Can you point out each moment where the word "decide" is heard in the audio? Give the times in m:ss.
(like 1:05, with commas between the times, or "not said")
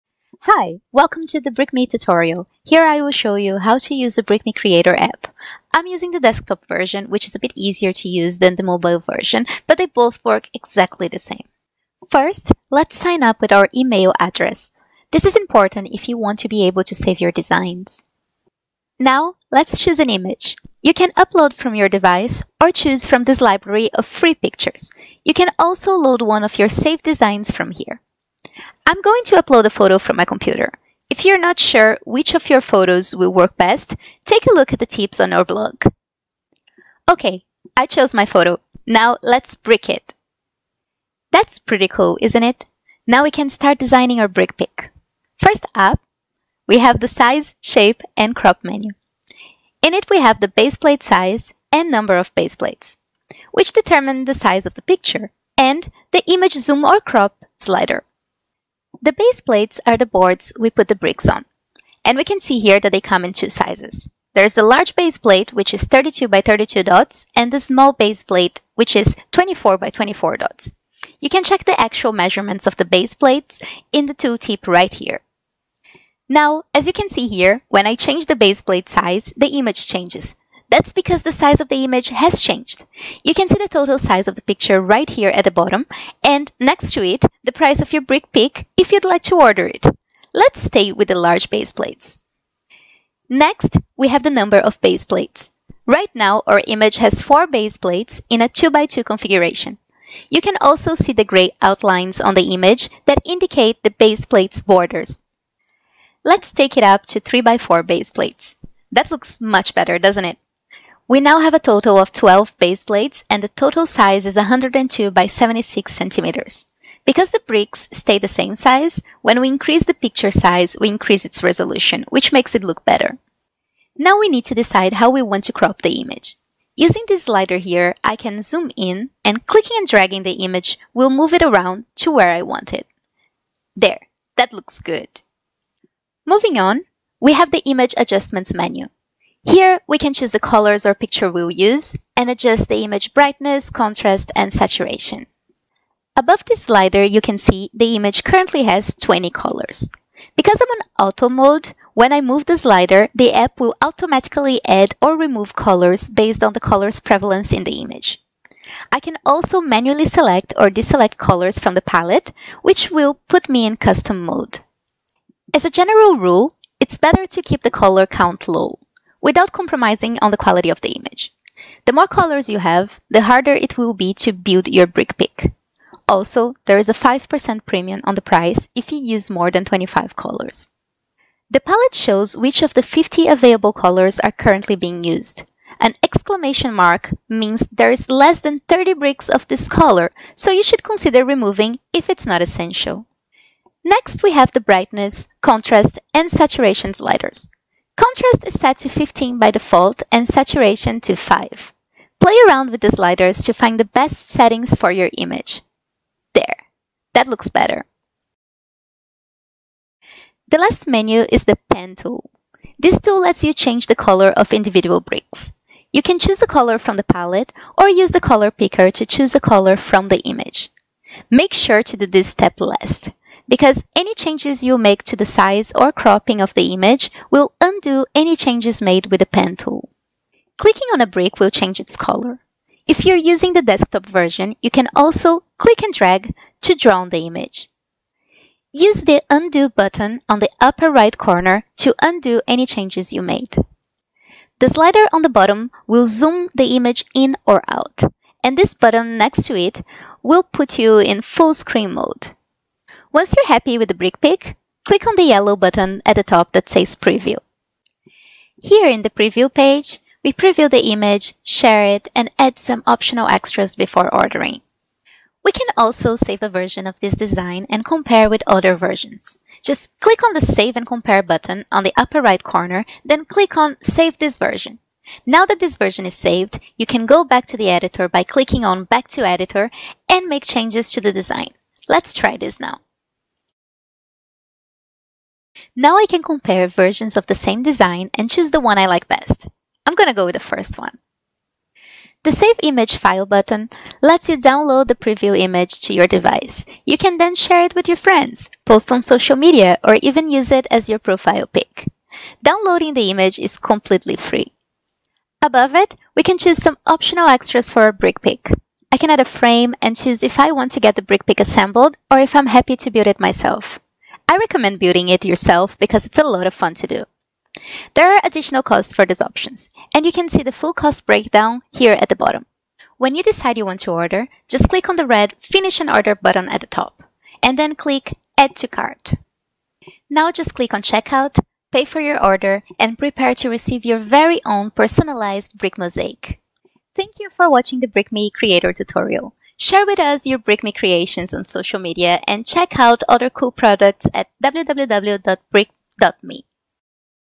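2:04, 5:23.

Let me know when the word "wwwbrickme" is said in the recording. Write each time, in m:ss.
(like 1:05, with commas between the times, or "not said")
5:44.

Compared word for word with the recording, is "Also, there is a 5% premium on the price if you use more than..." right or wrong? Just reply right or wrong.
right.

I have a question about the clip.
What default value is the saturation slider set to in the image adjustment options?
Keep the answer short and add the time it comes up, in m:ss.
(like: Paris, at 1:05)
5, at 3:20.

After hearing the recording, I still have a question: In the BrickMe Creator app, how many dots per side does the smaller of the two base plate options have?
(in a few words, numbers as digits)
24 by 24.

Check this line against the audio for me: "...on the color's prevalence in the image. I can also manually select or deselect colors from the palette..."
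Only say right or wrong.
right.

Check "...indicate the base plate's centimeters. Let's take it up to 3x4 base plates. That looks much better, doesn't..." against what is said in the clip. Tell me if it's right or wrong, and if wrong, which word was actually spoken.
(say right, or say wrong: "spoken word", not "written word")
wrong: "borders", not "centimeters".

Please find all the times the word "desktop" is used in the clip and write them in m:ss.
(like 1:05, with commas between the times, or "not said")
0:06, 3:53.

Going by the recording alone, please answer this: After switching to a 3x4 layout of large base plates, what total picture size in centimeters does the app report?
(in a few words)
102 by 76 centimeters.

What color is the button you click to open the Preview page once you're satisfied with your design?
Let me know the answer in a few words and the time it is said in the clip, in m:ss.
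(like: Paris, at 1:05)
Yellow, at 4:15.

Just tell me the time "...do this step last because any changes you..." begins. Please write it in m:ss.
3:41.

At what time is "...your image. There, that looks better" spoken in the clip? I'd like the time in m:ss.
3:24.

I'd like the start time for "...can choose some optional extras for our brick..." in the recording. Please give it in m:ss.
5:06.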